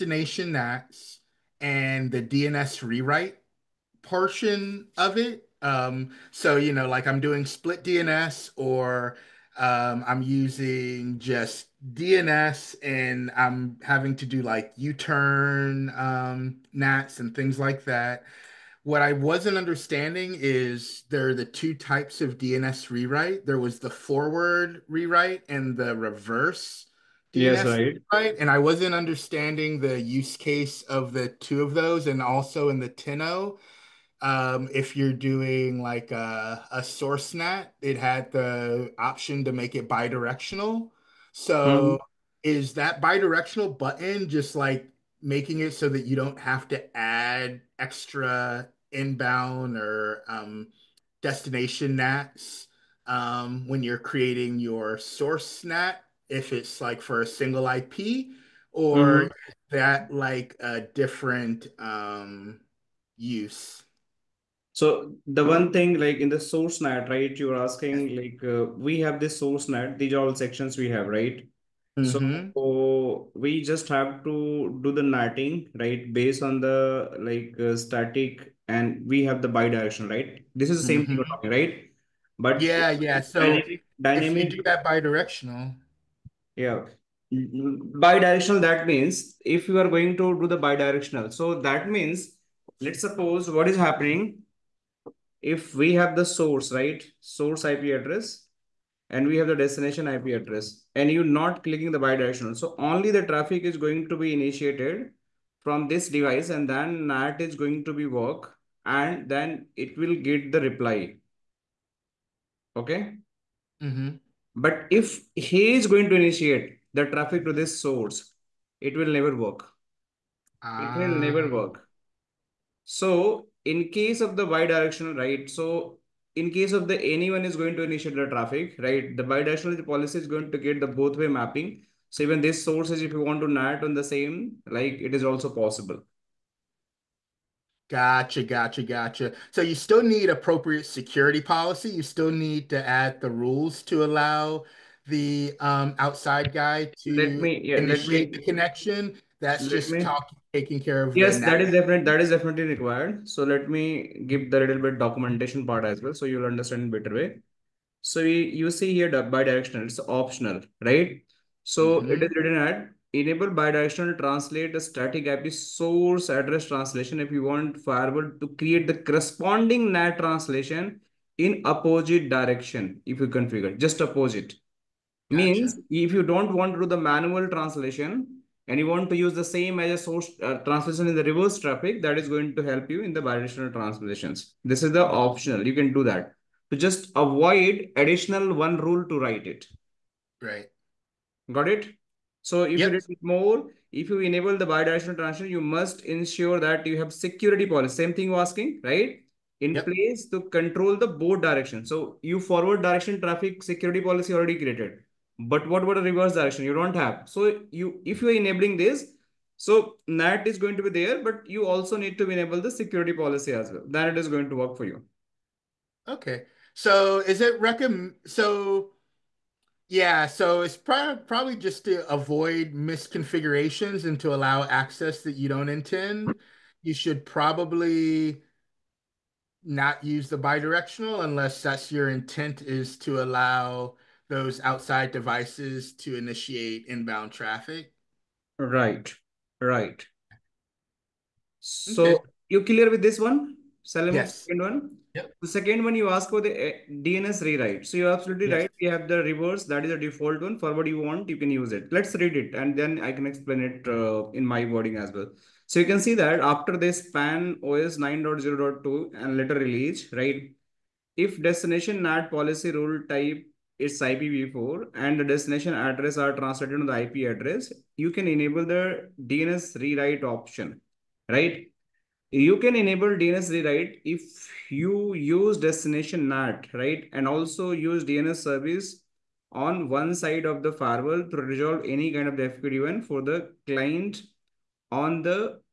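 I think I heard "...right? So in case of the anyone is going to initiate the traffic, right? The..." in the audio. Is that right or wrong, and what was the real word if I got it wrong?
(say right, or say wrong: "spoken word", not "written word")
right.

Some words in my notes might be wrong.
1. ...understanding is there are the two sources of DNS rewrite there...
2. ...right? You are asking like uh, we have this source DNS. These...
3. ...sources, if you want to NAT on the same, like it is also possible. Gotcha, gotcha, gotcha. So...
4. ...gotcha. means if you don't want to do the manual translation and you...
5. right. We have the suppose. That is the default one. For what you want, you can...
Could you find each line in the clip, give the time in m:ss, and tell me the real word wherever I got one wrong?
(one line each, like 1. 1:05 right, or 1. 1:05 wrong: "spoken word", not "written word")
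1. 0:19 wrong: "types", not "sources"
2. 1:07 wrong: "NAT", not "DNS"
3. 2:12 right
4. 2:54 right
5. 4:08 wrong: "reverse", not "suppose".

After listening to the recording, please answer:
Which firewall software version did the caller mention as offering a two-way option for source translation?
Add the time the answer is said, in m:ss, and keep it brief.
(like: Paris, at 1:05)
10.0, at 0:32.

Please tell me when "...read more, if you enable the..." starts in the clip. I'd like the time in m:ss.
3:13.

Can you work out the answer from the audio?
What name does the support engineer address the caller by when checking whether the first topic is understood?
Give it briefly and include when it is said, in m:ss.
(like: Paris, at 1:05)
Salim, at 4:03.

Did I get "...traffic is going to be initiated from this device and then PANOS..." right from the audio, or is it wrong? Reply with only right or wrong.
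wrong.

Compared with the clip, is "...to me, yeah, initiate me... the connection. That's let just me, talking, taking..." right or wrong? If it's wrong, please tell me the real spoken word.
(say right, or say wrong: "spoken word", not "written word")
right.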